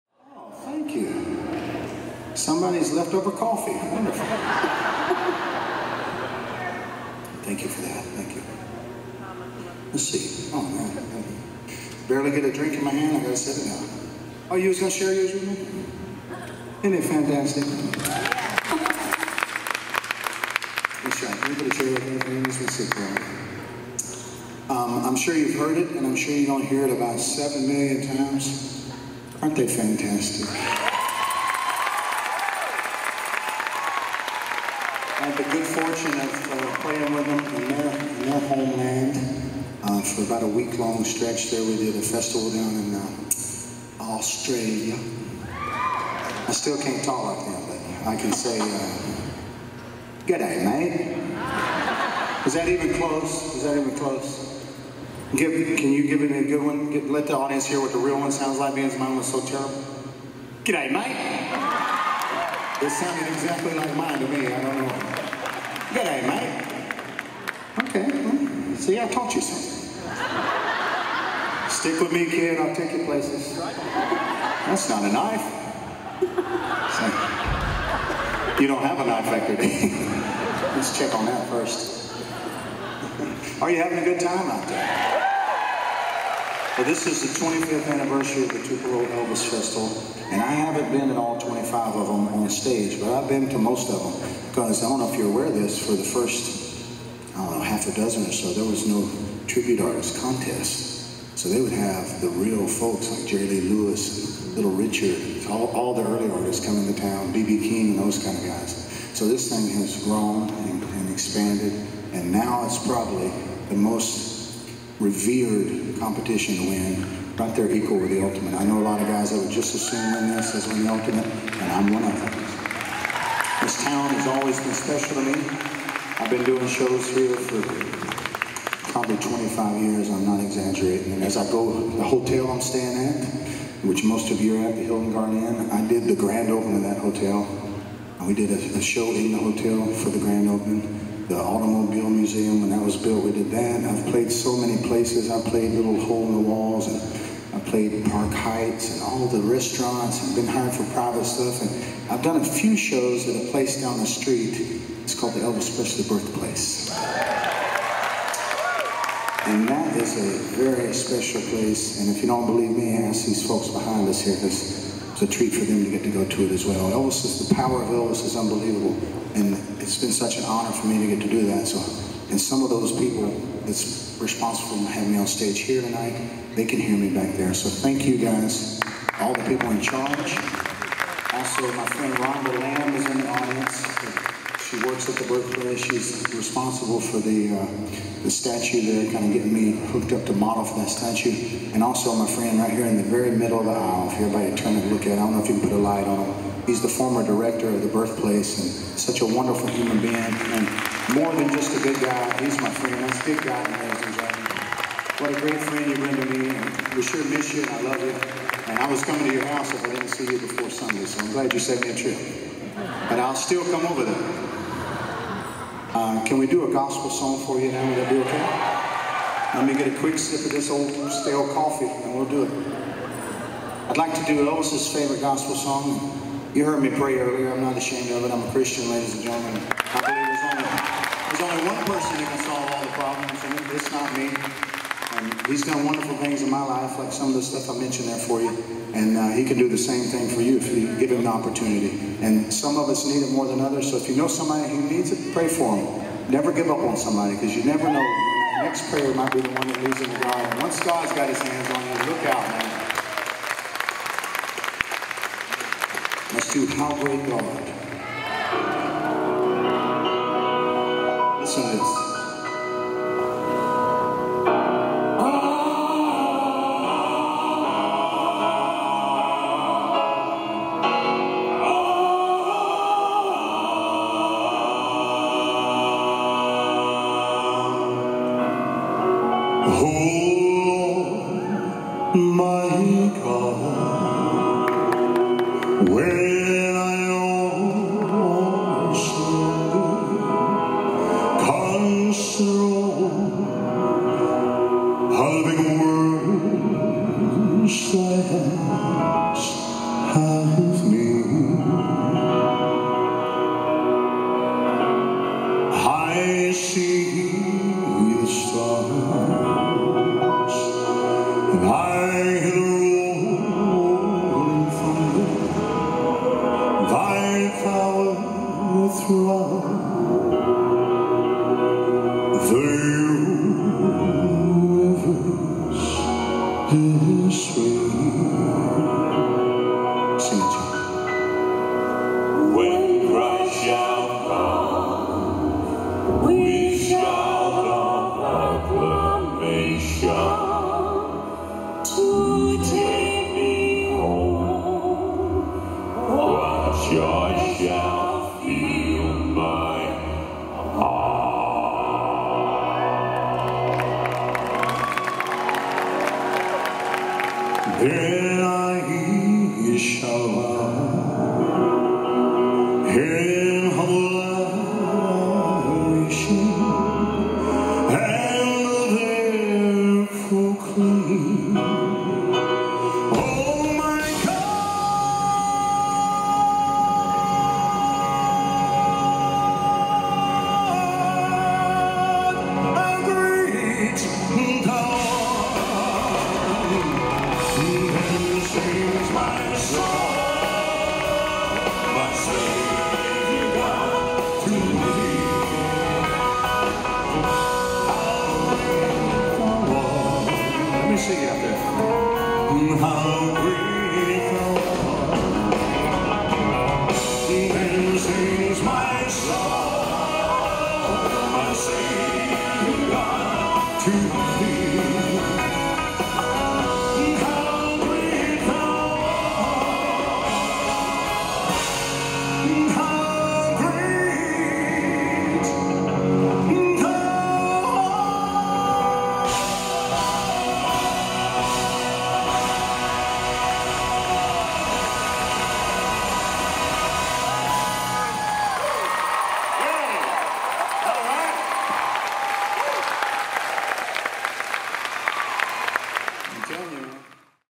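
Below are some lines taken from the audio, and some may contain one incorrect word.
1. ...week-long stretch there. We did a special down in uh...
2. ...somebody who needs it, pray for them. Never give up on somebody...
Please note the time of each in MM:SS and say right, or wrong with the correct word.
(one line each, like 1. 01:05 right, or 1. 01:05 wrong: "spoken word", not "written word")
1. 00:40 wrong: "festival", not "special"
2. 04:04 right.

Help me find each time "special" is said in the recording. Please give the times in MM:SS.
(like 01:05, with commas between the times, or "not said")
02:04, 02:40.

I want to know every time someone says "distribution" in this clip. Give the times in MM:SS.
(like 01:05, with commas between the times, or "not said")
not said.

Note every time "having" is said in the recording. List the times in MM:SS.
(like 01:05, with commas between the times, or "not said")
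01:23, 02:54.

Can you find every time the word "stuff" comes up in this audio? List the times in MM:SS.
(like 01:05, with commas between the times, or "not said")
02:31, 03:57.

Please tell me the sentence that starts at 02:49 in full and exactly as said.
And it's been such an honor for me to get to do that.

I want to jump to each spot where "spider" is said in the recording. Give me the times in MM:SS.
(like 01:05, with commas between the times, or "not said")
not said.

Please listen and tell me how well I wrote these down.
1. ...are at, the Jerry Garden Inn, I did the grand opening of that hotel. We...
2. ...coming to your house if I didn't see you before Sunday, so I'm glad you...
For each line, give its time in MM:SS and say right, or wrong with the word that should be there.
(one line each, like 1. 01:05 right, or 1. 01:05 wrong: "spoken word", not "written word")
1. 02:14 wrong: "Hilton", not "Jerry"
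2. 03:29 right.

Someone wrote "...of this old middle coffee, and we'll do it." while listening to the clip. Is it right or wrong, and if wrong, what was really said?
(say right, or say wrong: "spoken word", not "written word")
wrong: "stale", not "middle".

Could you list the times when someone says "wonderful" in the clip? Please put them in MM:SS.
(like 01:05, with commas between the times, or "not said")
00:03, 03:19, 03:55.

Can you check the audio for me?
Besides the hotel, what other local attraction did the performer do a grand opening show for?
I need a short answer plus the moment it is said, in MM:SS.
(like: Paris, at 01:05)
Automobile Museum, at 02:21.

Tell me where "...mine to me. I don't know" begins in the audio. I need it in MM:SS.
01:03.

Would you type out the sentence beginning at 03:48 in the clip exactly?
I'm a Christian, ladies and gentlemen.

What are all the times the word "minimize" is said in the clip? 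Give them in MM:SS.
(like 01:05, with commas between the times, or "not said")
not said.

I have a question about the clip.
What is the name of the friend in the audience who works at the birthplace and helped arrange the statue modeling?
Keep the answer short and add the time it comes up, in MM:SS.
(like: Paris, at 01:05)
Rhonda Lamb, at 03:02.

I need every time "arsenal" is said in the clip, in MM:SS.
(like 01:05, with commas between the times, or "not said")
not said.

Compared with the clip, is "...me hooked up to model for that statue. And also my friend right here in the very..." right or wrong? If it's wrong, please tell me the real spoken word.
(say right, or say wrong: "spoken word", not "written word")
right.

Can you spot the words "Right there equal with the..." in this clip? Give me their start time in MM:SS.
01:57.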